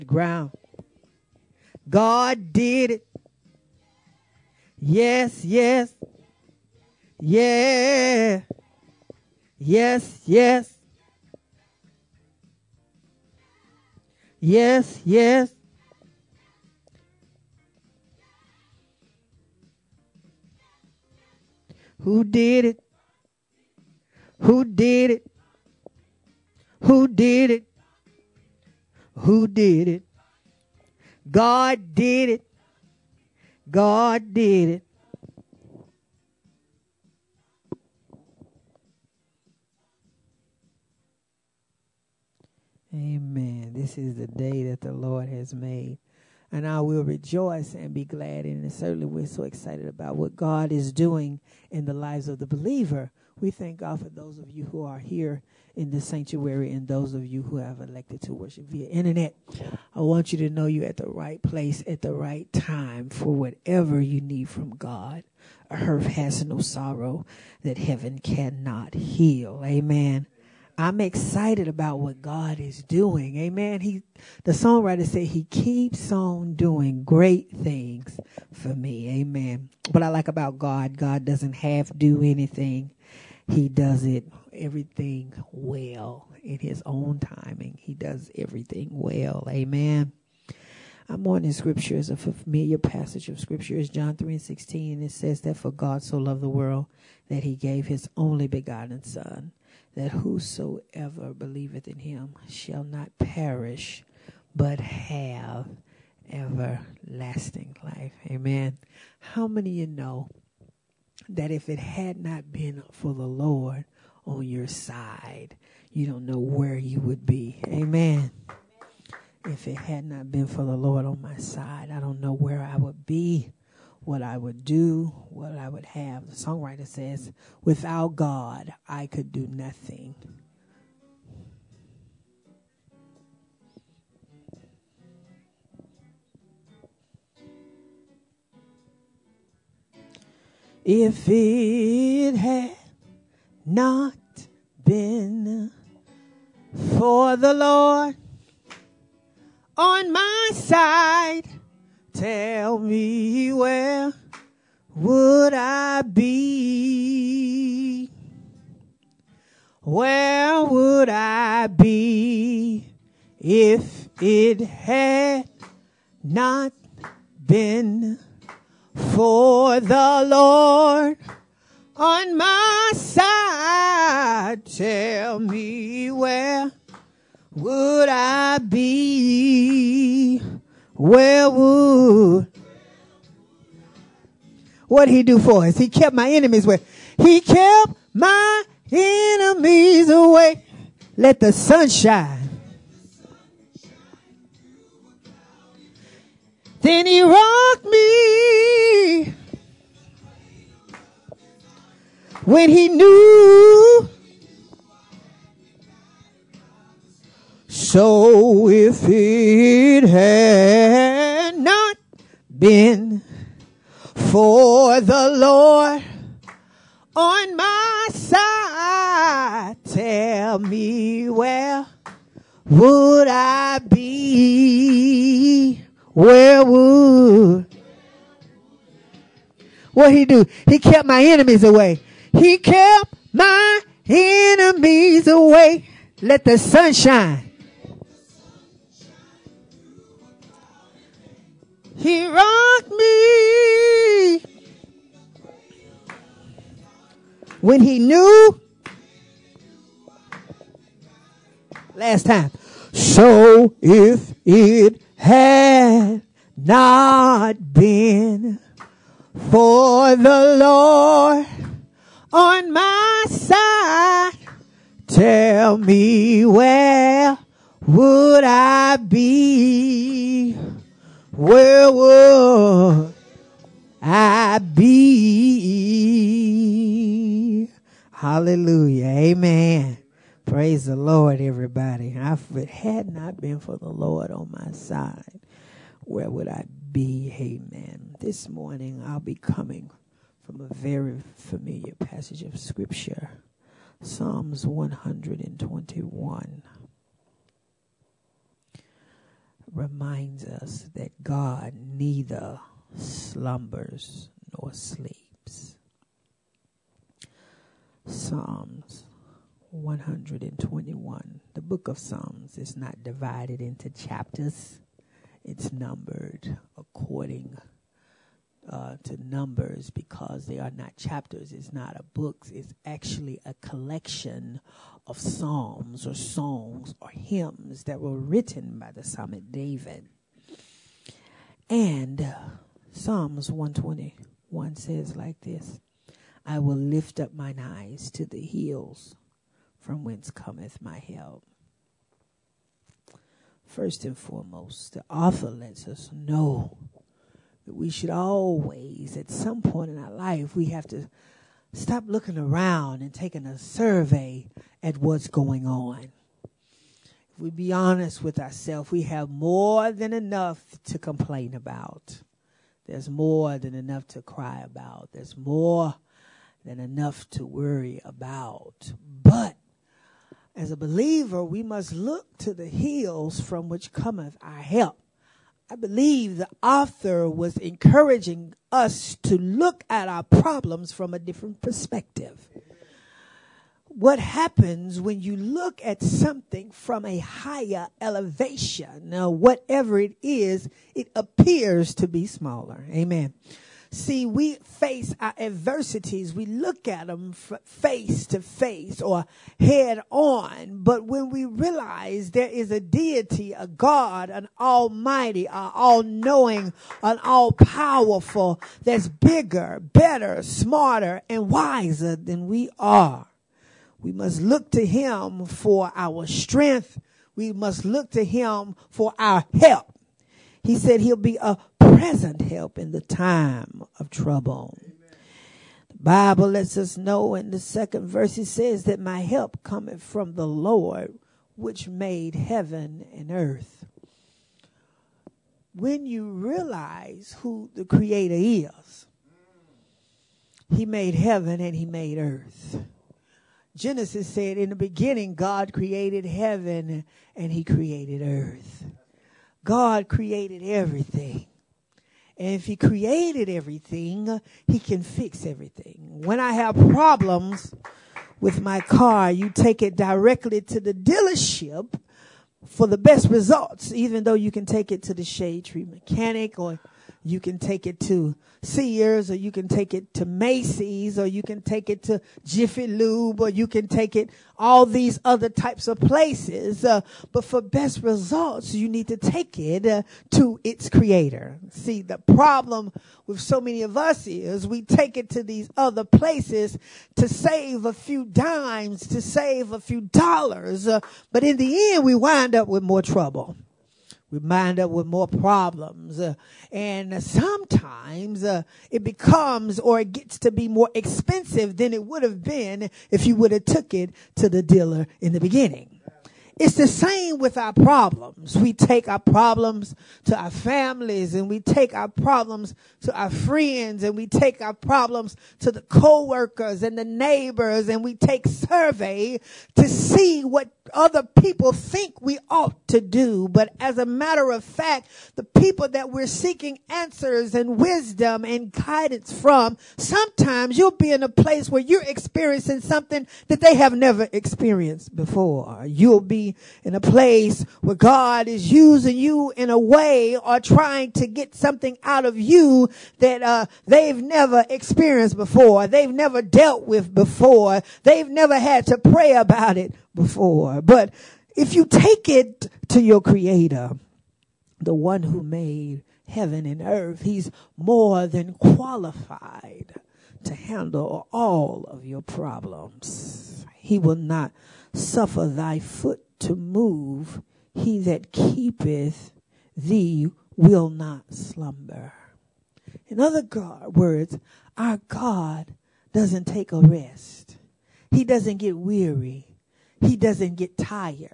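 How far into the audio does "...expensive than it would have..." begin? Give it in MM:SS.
08:20.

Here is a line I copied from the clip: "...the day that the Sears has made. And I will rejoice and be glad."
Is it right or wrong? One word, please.
wrong.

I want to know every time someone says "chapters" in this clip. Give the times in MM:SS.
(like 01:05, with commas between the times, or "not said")
05:13, 05:20.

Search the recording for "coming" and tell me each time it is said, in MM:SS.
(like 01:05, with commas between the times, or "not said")
04:49.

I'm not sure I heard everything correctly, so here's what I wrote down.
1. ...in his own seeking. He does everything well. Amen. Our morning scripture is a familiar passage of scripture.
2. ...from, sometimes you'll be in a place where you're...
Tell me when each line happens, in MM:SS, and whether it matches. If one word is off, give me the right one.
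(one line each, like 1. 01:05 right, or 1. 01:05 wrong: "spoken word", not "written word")
1. 01:26 wrong: "timing", not "seeking"
2. 08:49 right.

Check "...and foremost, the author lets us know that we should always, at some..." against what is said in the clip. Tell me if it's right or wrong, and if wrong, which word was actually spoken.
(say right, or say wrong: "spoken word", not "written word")
right.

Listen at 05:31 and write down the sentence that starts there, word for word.
And Psalms 121 says like this I will lift up mine eyes to the hills from whence cometh my help.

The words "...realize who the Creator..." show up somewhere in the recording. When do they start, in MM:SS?
07:16.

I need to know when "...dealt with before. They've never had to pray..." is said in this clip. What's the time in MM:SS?
09:06.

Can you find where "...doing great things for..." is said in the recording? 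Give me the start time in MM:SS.
01:16.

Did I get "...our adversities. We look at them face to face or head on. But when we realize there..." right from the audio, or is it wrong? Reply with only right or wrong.
right.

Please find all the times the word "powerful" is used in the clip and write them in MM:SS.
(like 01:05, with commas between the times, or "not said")
06:47.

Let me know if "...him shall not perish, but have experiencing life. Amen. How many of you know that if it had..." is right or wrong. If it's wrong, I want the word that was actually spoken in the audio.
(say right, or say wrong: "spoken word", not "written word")
wrong: "everlasting", not "experiencing".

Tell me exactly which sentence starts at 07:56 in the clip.
Uh, but for best results, you need to take it uh, to its creator.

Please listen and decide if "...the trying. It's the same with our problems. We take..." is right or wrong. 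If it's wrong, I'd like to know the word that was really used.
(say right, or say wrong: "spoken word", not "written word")
wrong: "beginning", not "trying".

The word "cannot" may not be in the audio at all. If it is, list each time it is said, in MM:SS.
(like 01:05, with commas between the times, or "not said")
01:08.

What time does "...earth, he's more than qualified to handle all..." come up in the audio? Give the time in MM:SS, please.
09:16.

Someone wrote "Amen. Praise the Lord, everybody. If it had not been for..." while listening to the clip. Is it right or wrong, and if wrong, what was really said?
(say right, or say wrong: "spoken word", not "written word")
right.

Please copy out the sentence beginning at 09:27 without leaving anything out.
He that keepeth thee will not slumber.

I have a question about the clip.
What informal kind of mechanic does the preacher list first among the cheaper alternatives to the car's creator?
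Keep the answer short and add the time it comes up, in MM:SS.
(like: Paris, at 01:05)
shade tree mechanic, at 07:45.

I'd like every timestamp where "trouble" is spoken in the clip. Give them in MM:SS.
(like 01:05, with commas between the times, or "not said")
07:04, 08:13.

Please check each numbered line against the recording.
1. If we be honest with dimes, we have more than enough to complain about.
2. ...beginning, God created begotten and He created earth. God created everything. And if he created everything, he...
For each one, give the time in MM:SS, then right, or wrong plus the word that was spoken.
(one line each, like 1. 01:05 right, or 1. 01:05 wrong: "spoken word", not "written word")
1. 05:56 wrong: "ourselves", not "dimes"
2. 07:24 wrong: "heaven", not "begotten".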